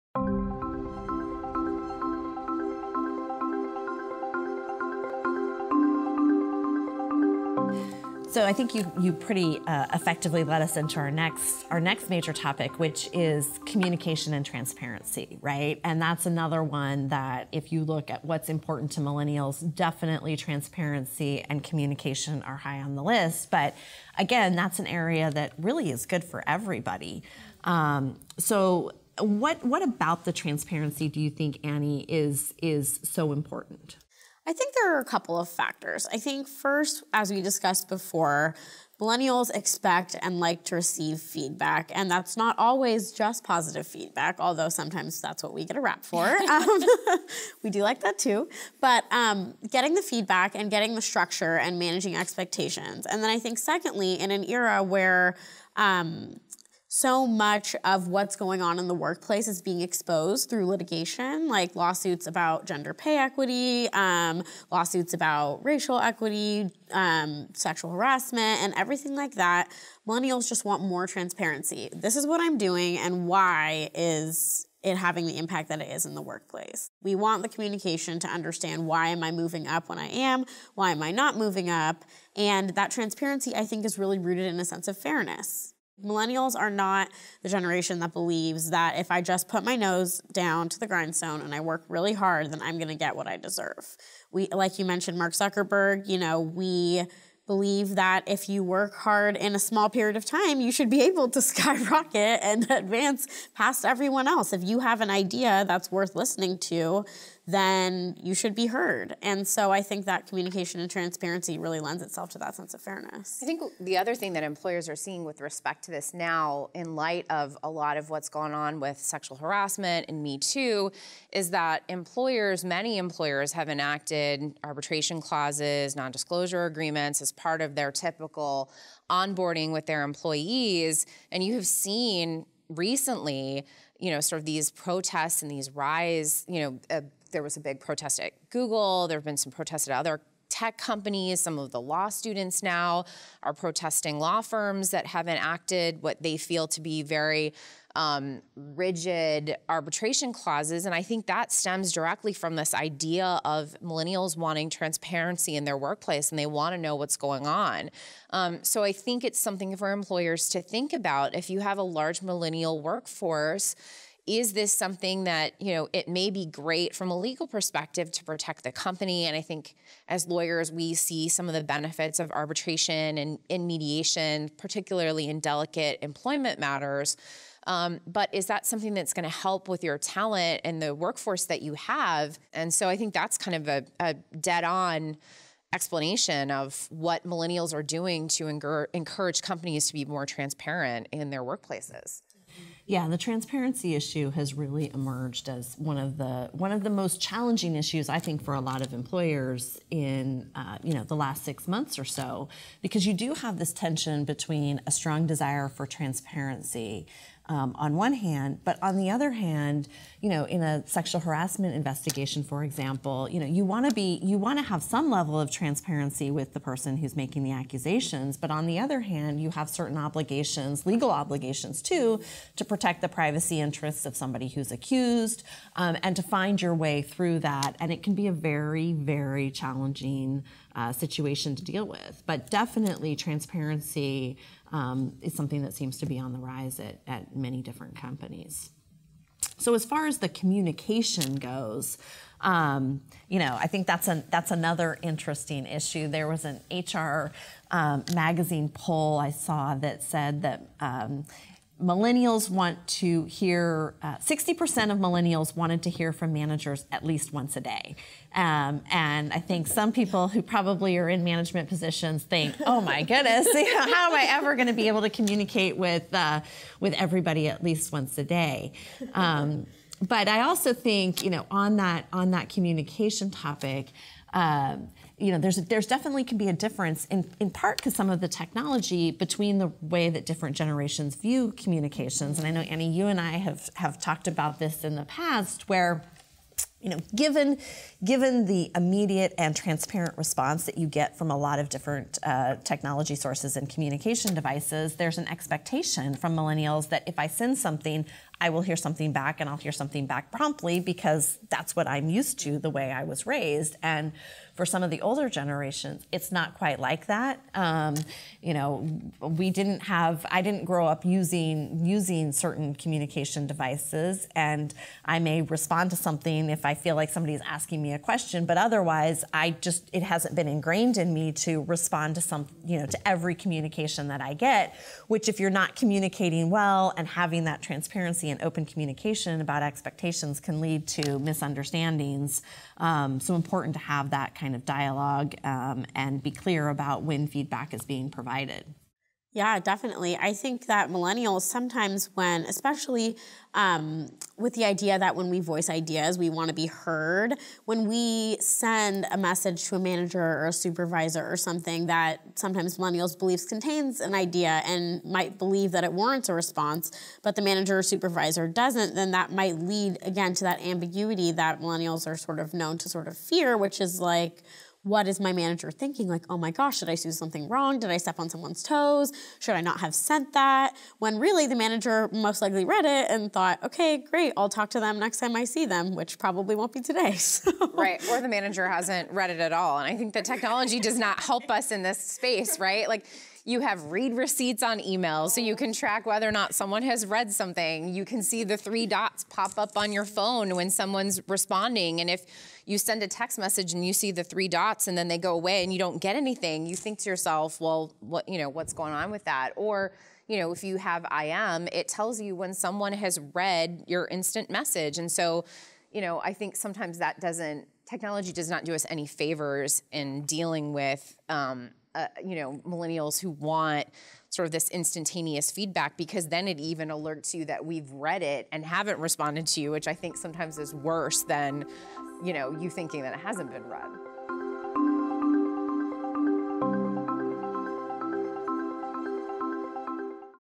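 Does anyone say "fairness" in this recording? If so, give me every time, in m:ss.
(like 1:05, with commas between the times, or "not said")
1:24, 1:52.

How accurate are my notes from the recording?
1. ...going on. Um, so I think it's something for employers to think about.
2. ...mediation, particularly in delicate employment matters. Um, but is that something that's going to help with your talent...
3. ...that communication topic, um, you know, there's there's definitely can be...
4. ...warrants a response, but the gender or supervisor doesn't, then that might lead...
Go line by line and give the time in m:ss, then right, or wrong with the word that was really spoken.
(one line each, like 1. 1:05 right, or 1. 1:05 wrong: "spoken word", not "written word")
1. 2:37 right
2. 2:53 right
3. 4:32 right
4. 5:55 wrong: "manager", not "gender".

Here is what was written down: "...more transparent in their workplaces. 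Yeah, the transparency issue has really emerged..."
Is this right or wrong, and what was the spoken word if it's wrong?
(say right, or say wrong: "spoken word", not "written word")
right.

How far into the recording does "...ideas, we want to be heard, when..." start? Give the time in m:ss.
5:45.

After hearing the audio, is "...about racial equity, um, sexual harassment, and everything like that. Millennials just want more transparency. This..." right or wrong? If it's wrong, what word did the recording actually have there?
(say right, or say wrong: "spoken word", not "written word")
right.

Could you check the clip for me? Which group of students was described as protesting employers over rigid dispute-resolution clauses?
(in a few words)
Law students.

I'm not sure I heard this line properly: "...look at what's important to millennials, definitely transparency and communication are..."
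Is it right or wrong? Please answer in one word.
right.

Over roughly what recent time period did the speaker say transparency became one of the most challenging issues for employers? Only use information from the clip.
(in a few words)
Last six months.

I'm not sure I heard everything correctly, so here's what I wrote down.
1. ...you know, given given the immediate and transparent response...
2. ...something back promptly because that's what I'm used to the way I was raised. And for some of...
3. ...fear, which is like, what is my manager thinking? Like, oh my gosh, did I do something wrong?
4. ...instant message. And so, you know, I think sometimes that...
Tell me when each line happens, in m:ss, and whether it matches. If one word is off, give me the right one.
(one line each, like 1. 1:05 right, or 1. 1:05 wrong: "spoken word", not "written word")
1. 4:46 right
2. 4:59 right
3. 6:03 right
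4. 6:44 right.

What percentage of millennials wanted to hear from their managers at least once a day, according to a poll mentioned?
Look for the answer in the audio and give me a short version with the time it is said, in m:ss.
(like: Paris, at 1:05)
60%, at 4:14.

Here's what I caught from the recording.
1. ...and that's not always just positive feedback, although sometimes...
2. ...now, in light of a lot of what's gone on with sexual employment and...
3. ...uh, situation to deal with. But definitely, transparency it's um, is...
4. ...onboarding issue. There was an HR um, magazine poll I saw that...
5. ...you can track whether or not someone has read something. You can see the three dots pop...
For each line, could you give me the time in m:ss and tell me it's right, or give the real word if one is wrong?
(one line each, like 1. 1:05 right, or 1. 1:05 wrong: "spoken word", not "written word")
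1. 0:41 right
2. 1:56 wrong: "harassment", not "employment"
3. 3:50 right
4. 4:05 wrong: "interesting", not "onboarding"
5. 6:25 right.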